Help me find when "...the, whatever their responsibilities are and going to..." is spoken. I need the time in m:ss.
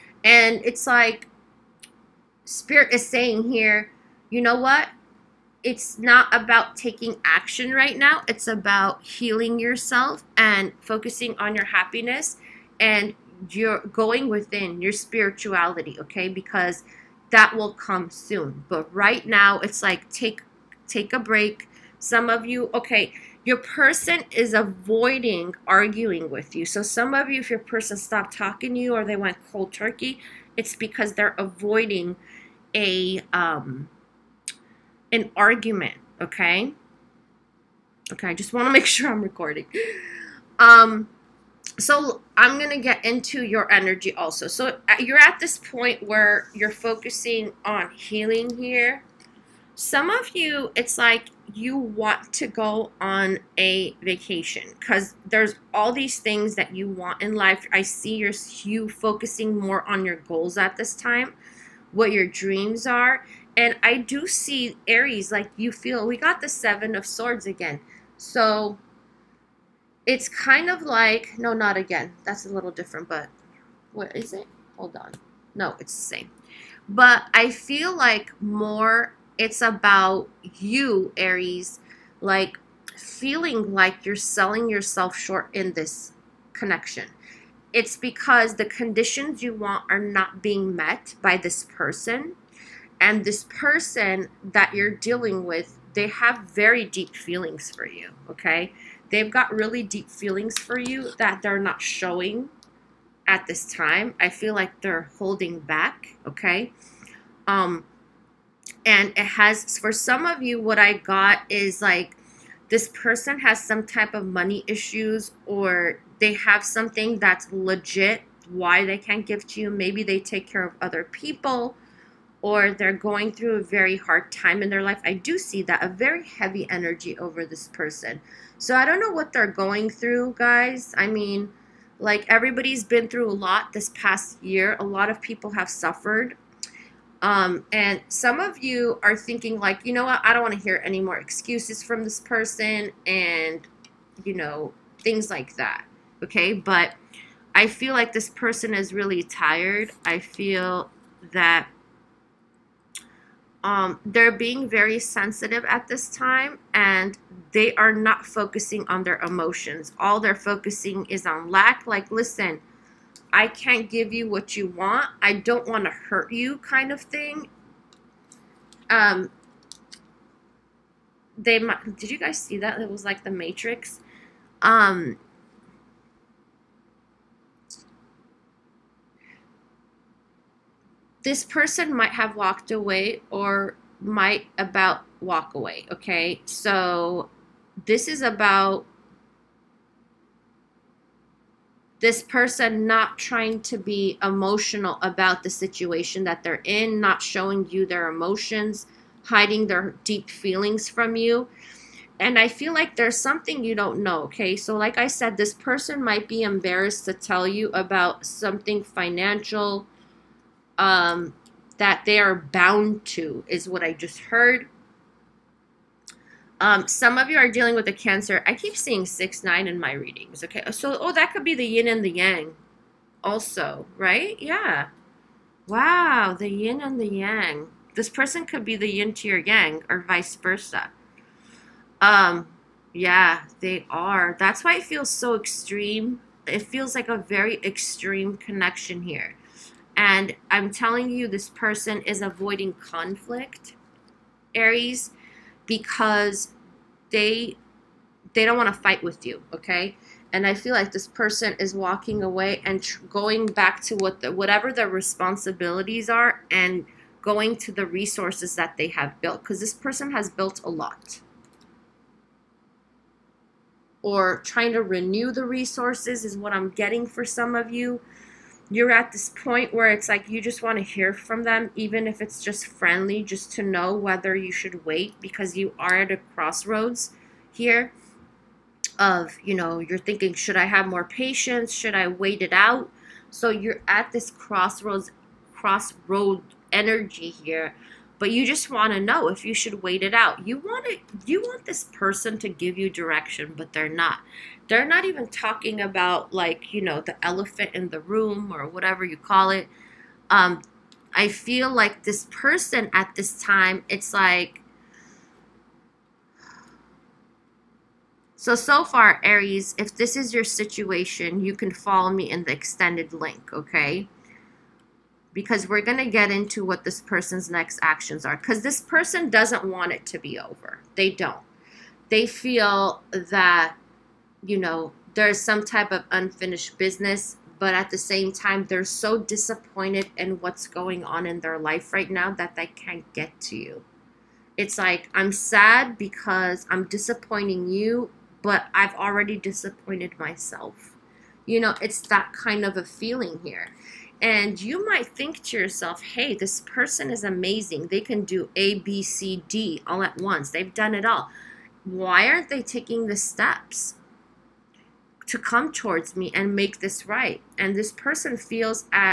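4:14.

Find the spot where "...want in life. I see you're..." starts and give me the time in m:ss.
0:56.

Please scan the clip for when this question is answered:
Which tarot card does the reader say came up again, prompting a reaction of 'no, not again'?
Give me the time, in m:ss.
1:06.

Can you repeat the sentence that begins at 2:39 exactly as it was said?
All they're focusing is on lack.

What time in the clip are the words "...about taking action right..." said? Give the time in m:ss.
0:06.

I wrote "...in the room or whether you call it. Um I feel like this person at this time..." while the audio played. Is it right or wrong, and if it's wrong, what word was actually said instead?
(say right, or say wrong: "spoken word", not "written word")
wrong: "whatever", not "whether".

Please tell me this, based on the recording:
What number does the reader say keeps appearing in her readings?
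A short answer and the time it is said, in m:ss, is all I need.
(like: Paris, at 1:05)
69, at 3:39.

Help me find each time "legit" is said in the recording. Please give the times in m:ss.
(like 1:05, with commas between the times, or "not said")
1:57.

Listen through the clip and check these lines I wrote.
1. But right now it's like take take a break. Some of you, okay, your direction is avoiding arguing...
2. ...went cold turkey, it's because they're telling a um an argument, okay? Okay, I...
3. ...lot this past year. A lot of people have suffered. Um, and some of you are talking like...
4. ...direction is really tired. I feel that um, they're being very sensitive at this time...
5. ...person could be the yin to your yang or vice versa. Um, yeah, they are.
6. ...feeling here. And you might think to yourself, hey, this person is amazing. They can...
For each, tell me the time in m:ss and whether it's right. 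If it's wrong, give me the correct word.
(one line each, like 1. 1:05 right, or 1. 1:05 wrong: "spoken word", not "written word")
1. 0:18 wrong: "person", not "direction"
2. 0:29 wrong: "avoiding", not "telling"
3. 2:13 wrong: "thinking", not "talking"
4. 2:28 wrong: "person", not "direction"
5. 3:48 right
6. 5:42 right.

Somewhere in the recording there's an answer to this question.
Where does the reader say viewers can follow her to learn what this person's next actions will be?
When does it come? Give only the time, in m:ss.
5:12.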